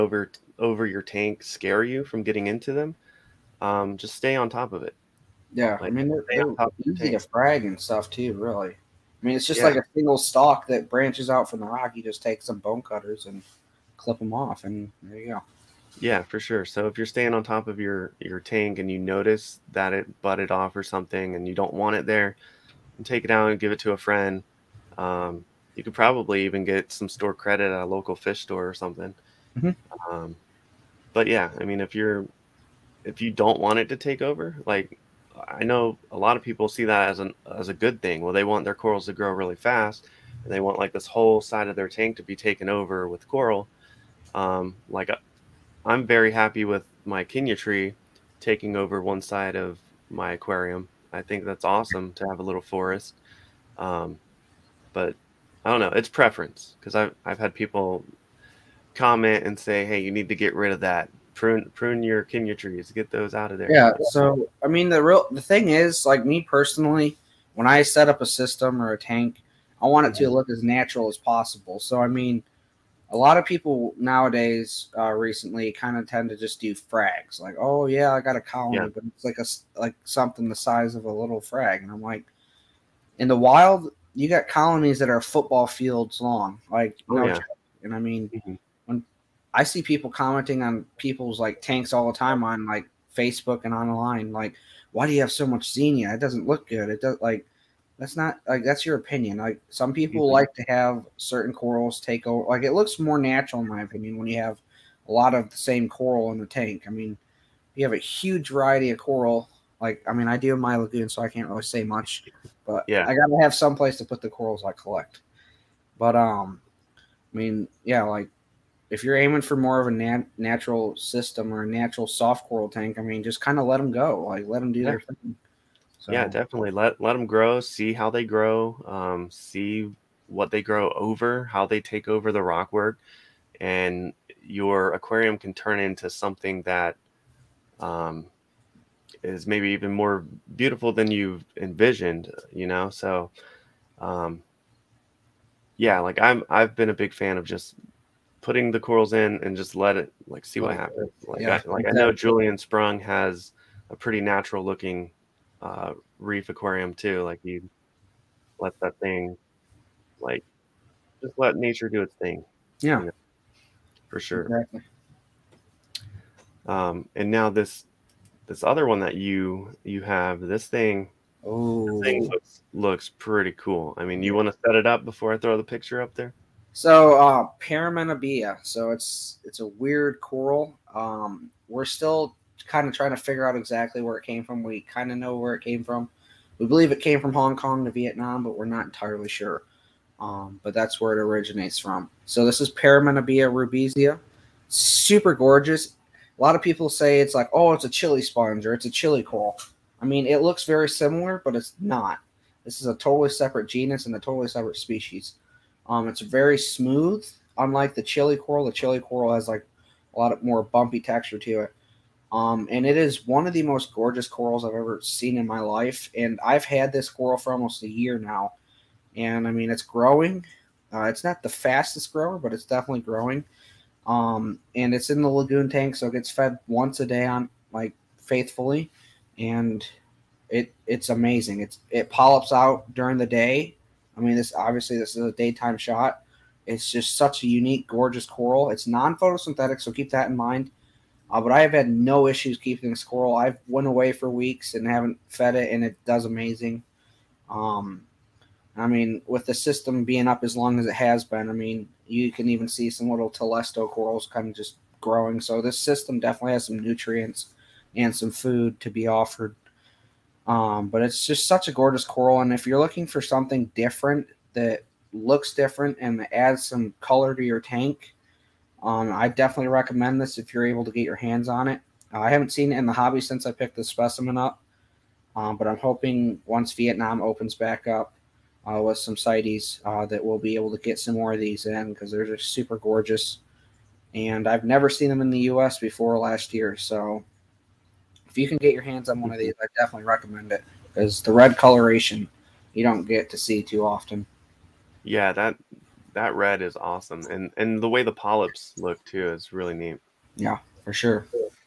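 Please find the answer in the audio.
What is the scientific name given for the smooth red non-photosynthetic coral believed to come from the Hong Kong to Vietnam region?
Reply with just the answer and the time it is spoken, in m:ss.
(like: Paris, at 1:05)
Paraminabea rubisia, at 3:12.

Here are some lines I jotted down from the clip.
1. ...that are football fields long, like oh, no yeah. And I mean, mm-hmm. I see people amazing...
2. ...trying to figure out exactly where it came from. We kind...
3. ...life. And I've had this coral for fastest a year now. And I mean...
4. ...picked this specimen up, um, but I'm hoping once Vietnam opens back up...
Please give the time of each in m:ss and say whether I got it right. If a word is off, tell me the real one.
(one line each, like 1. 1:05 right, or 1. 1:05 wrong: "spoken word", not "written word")
1. 1:24 wrong: "commenting", not "amazing"
2. 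3:02 right
3. 3:35 wrong: "almost", not "fastest"
4. 4:33 right.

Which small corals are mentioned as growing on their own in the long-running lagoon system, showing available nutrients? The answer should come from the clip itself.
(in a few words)
Telesto corals.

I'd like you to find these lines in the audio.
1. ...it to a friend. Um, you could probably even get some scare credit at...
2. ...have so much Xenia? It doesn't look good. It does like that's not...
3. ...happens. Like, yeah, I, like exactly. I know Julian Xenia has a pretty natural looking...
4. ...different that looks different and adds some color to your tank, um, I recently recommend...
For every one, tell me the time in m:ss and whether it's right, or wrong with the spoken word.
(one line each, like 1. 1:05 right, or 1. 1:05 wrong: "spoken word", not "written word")
1. 0:23 wrong: "store", not "scare"
2. 1:35 right
3. 2:30 wrong: "Sprung", not "Xenia"
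4. 4:23 wrong: "definitely", not "recently".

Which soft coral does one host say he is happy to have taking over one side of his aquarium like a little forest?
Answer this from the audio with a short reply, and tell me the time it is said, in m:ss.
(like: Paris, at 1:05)
Kenya tree, at 0:47.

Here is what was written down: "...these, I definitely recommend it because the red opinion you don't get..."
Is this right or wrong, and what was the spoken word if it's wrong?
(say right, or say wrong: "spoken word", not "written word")
wrong: "coloration", not "opinion".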